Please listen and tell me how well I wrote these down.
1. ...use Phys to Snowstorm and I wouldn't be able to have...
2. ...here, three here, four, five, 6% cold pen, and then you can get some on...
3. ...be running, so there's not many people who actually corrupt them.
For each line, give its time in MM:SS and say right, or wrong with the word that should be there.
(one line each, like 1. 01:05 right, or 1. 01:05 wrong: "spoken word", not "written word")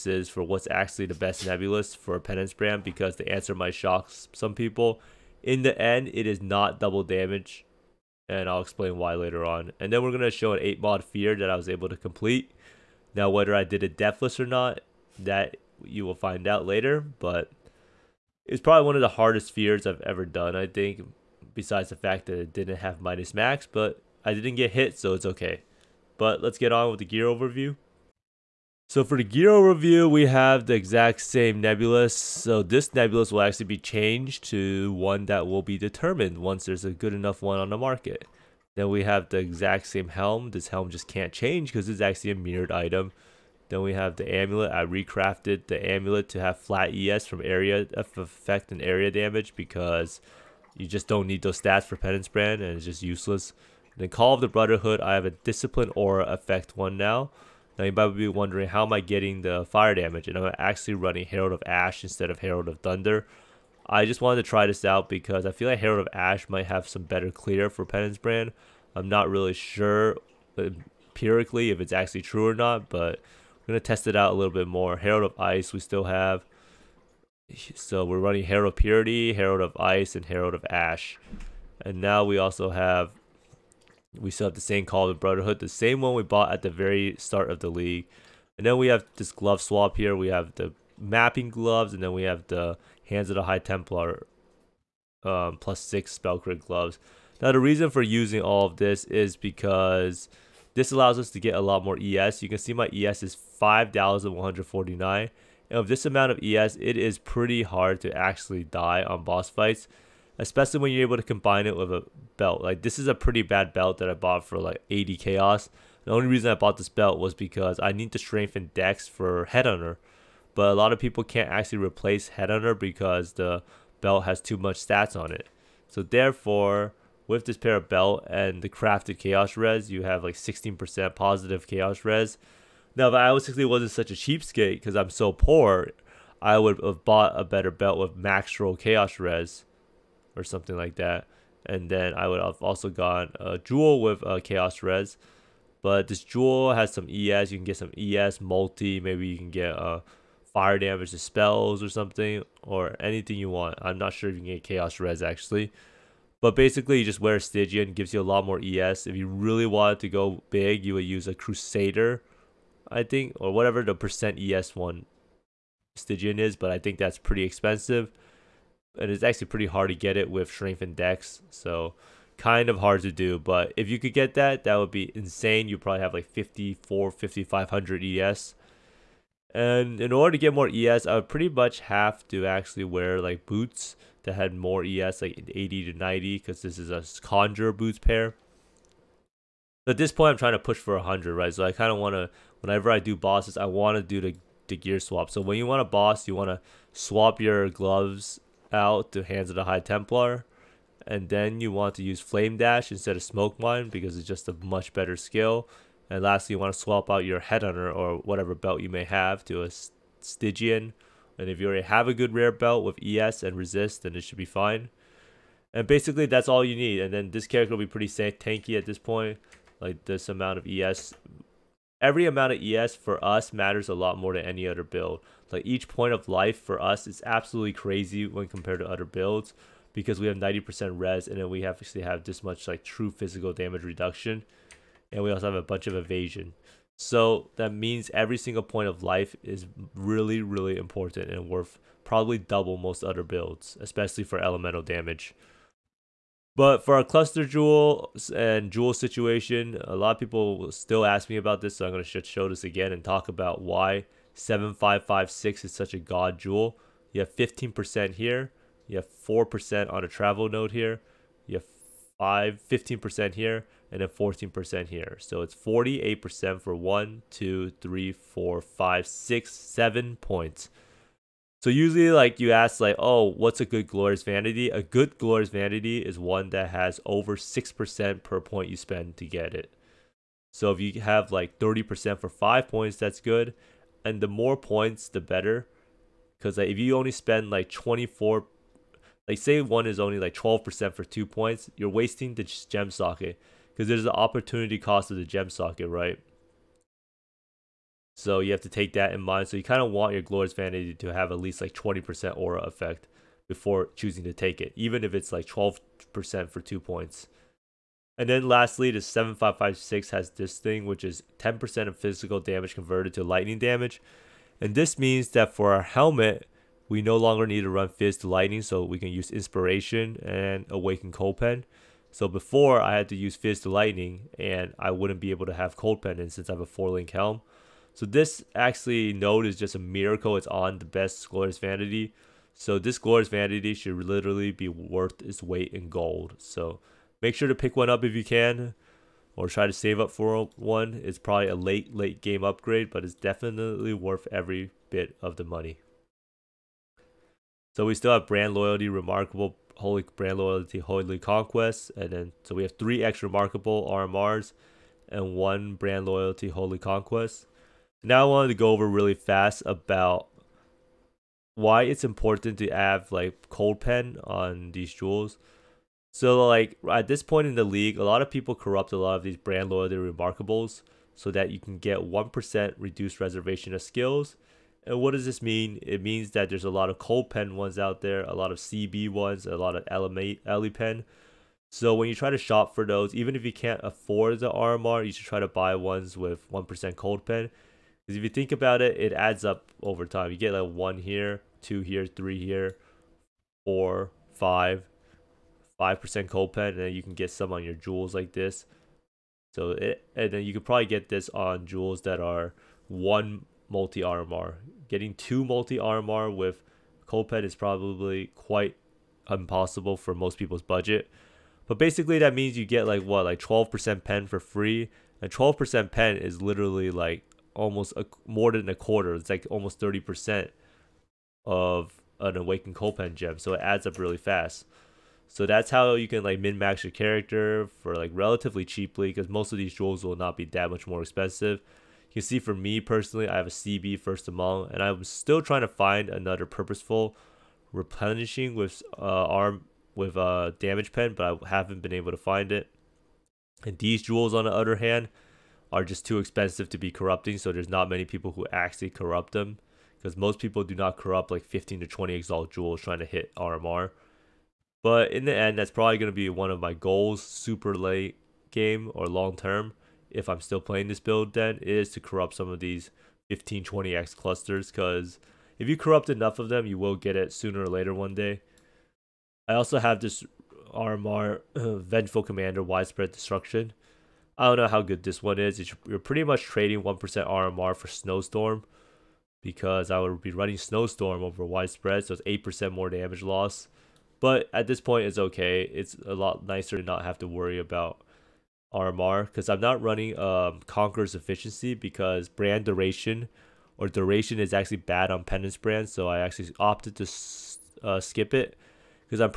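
1. 05:23 wrong: "Lightning", not "Snowstorm"
2. 06:31 wrong: "5", not "6"
3. 07:26 wrong: "corrupting", not "running".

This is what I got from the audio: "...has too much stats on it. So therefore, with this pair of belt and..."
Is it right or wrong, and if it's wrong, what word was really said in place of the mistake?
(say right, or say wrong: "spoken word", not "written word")
right.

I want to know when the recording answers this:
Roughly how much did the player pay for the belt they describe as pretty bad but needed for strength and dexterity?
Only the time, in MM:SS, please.
01:54.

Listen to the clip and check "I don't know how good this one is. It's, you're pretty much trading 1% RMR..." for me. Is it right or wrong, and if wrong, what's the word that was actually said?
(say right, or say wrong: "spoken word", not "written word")
right.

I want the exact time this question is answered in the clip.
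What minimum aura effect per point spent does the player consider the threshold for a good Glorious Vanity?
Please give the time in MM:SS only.
04:37.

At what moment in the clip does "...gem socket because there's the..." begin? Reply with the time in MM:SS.
04:52.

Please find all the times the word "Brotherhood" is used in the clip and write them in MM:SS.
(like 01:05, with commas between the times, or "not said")
00:54, 01:25.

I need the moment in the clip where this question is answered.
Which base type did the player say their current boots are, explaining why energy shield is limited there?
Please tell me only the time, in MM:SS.
03:07.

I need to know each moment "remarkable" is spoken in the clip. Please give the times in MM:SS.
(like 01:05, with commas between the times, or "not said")
05:48, 05:53, 06:09.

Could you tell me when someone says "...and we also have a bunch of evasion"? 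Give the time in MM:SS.
03:55.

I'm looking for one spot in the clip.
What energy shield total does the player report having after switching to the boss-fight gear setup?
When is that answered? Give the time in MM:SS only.
01:43.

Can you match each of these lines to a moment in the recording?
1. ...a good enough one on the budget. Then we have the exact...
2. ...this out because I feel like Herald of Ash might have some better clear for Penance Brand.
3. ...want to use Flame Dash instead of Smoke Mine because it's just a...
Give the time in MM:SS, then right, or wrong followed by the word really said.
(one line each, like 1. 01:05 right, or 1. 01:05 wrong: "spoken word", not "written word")
1. 00:36 wrong: "market", not "budget"
2. 01:04 right
3. 03:21 right.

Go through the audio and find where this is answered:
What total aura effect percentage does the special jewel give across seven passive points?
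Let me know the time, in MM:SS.
04:25.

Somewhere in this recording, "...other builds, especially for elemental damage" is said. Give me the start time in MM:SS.
04:03.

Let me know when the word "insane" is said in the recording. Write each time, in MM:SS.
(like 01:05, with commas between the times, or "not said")
02:55.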